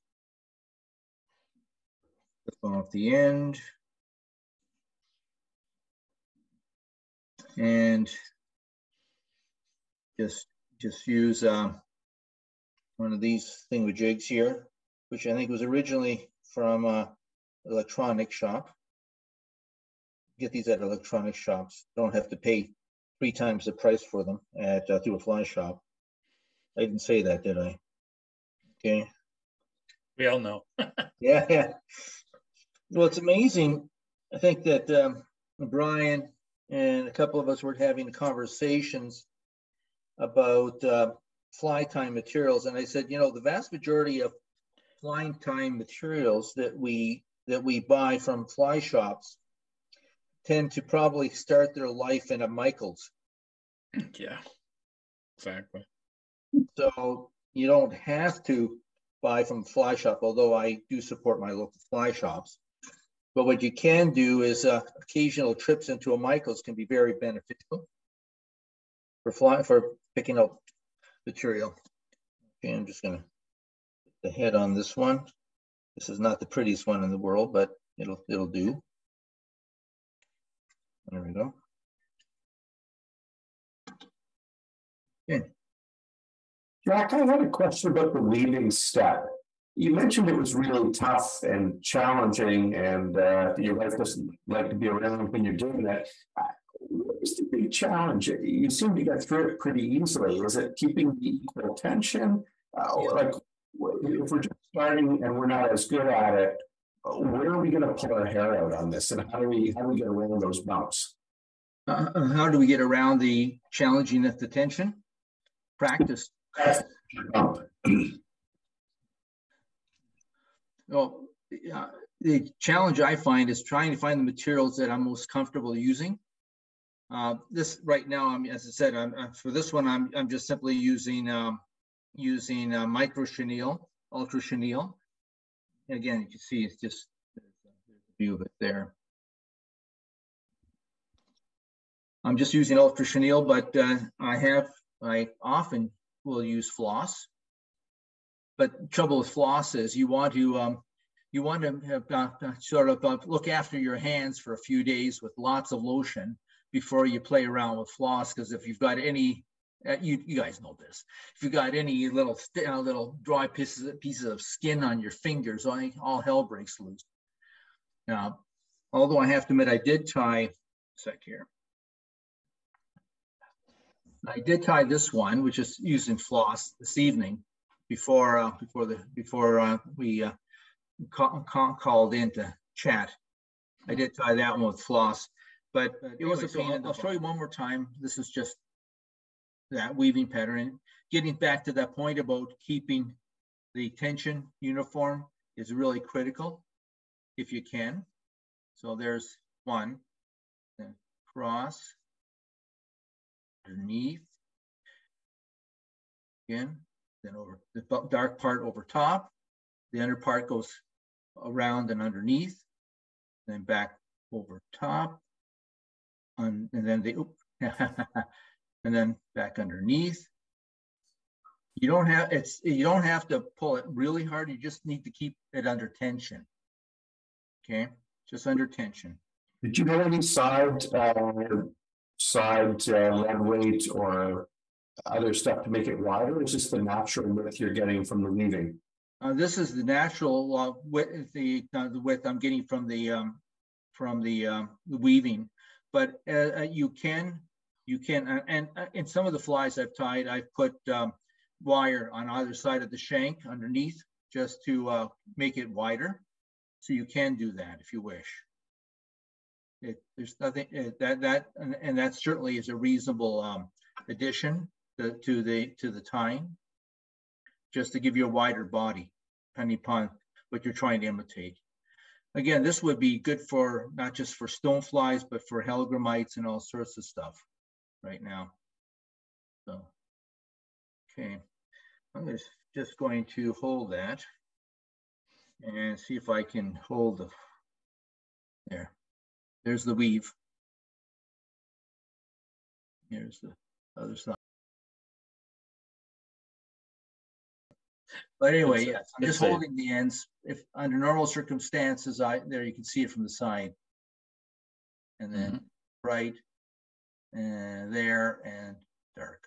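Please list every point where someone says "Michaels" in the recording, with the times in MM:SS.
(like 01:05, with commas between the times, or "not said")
00:52, 01:06.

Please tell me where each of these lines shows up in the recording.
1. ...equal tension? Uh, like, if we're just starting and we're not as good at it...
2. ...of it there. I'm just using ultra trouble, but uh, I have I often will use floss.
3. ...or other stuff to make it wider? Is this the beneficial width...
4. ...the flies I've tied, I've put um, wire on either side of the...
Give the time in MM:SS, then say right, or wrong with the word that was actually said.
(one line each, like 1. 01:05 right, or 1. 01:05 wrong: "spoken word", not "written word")
1. 01:41 right
2. 02:18 wrong: "chenille", not "trouble"
3. 03:53 wrong: "natural", not "beneficial"
4. 04:09 right.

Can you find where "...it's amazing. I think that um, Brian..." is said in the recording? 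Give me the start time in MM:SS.
00:33.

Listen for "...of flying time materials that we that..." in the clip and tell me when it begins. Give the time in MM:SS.
00:44.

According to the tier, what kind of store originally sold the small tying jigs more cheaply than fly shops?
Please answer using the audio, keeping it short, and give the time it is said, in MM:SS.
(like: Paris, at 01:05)
electronic shop, at 00:17.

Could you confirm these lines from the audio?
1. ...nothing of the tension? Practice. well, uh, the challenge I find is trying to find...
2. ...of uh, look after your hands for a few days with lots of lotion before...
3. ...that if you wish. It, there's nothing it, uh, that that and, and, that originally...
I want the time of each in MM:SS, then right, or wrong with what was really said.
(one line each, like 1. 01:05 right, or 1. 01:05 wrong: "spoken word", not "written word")
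1. 01:53 wrong: "challenging", not "nothing"
2. 02:32 right
3. 04:17 wrong: "certainly", not "originally".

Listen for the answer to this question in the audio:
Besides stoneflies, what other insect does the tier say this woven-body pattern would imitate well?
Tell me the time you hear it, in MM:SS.
04:35.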